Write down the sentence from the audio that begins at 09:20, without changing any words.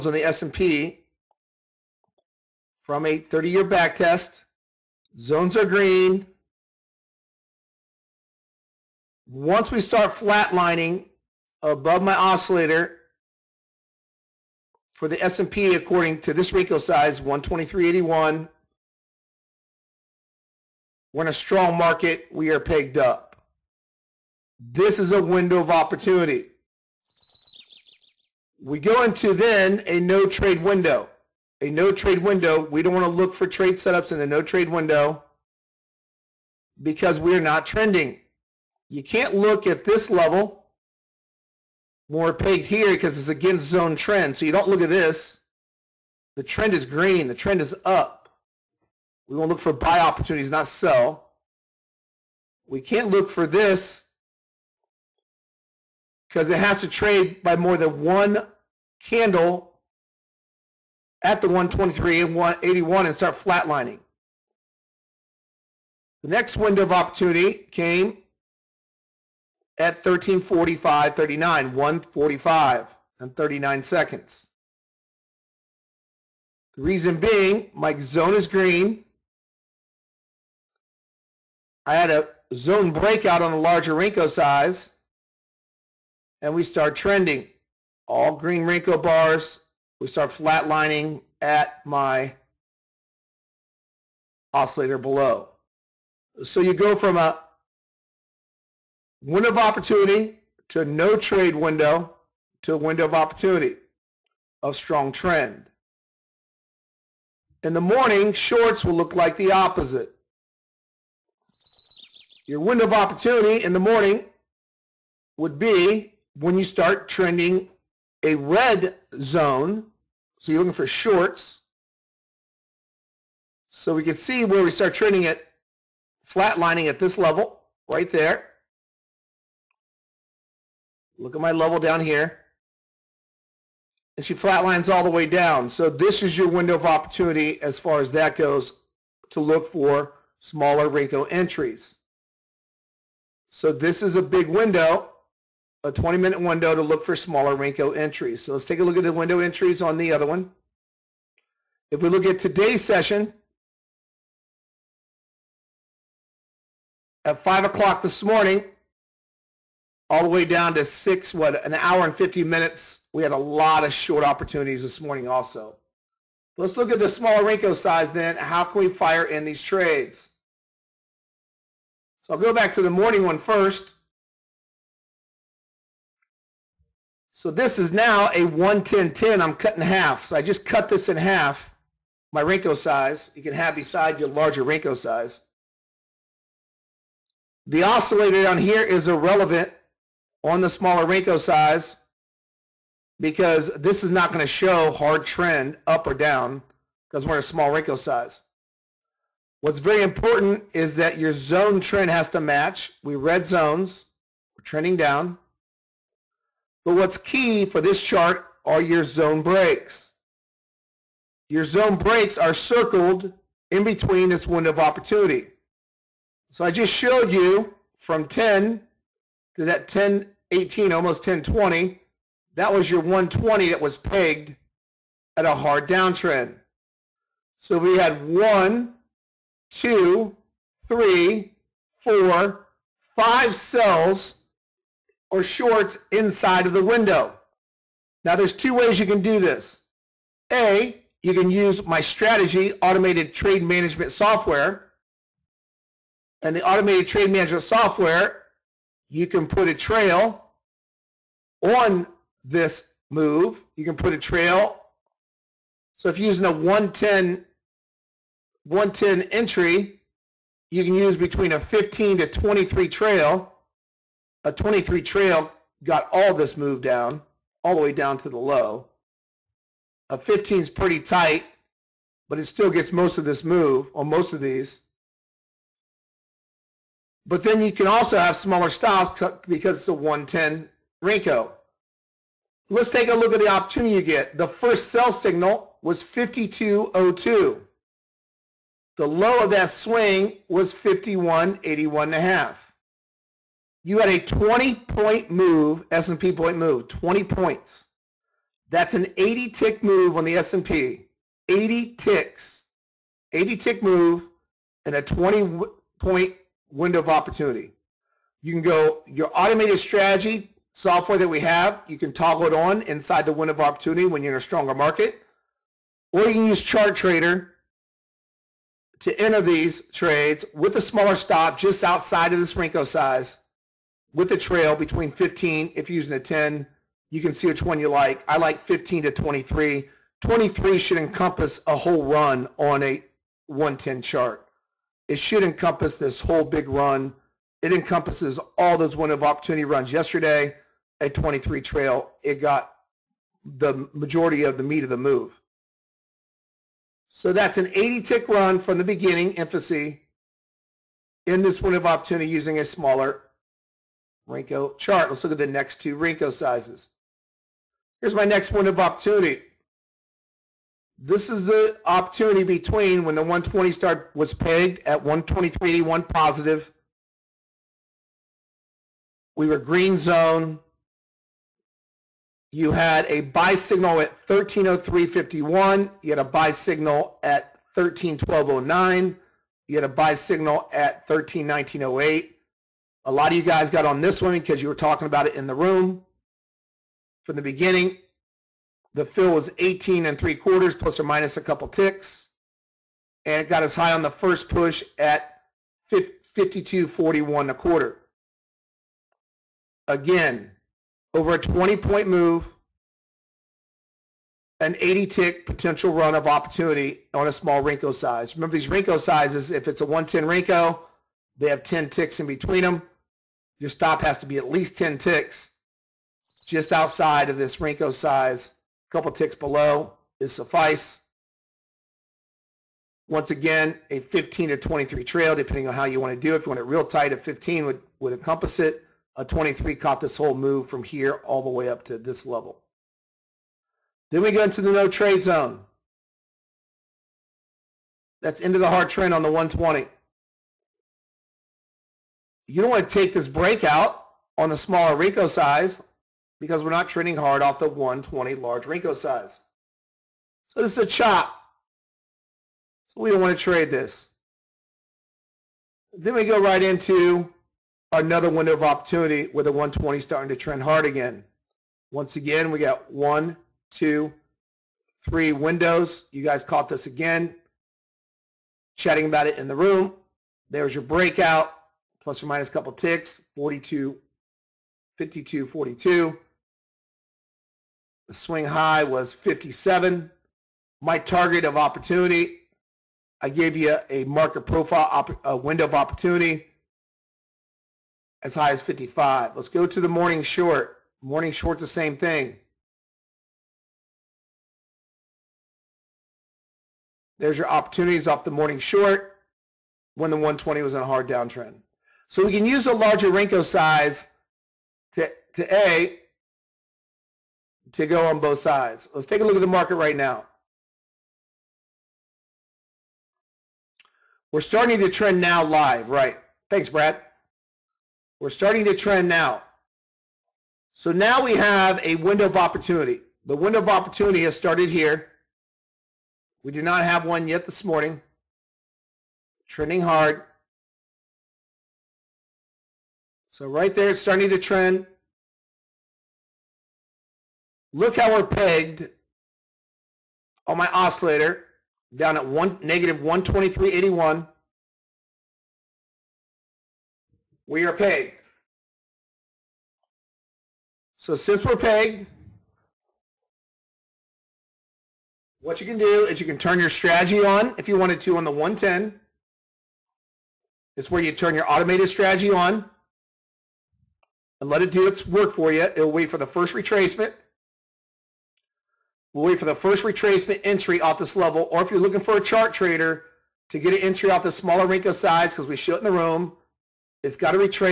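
It's where you turn your automated strategy on and let it do its work for you.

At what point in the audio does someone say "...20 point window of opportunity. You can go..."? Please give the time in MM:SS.
05:05.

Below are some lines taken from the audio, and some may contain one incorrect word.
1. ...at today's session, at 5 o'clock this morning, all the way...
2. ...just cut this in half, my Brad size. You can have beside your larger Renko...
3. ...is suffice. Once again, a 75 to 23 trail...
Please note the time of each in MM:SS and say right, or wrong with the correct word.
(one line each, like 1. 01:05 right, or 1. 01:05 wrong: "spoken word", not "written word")
1. 02:32 right
2. 03:00 wrong: "Renko", not "Brad"
3. 07:00 wrong: "15", not "75".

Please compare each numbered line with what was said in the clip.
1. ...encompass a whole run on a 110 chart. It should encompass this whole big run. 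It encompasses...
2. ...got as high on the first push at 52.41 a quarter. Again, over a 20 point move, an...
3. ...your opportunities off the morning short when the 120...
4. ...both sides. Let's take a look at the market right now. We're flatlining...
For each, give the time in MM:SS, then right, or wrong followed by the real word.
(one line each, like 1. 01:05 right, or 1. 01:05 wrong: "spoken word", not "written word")
1. 05:30 right
2. 06:33 right
3. 08:17 right
4. 08:28 wrong: "starting", not "flatlining".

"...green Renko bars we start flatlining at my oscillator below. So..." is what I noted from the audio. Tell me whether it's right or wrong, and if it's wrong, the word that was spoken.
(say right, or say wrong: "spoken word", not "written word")
right.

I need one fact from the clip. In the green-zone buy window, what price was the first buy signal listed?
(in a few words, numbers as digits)
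1303.51.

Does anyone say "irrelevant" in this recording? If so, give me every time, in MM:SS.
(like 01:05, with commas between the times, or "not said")
03:09.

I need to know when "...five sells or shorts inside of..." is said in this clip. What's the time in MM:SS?
03:53.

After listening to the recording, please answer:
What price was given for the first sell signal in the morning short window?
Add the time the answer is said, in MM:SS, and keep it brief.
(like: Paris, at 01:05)
52.02, at 04:46.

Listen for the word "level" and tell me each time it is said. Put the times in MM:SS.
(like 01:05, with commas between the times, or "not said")
00:40, 02:07, 02:11, 07:12, 09:31.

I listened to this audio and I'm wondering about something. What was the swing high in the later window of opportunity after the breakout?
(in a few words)
57.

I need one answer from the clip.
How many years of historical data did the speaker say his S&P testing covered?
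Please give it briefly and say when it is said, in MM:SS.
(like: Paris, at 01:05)
30, at 00:03.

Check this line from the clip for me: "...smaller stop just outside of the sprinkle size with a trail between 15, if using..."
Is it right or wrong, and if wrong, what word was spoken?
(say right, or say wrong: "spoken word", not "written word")
right.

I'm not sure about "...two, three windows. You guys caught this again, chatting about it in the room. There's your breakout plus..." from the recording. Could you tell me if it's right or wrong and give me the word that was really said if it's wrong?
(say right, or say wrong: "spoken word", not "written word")
right.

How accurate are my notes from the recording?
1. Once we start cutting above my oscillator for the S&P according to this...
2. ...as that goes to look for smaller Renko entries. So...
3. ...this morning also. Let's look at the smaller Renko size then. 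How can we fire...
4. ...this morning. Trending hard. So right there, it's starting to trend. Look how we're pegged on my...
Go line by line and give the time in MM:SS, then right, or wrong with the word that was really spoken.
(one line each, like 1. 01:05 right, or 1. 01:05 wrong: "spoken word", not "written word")
1. 00:09 wrong: "flatlining", not "cutting"
2. 02:18 right
3. 02:44 right
4. 08:47 right.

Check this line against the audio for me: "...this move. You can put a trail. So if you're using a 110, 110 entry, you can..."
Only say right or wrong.
right.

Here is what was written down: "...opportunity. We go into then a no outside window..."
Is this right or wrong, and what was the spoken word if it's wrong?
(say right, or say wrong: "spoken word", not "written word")
wrong: "trade", not "outside".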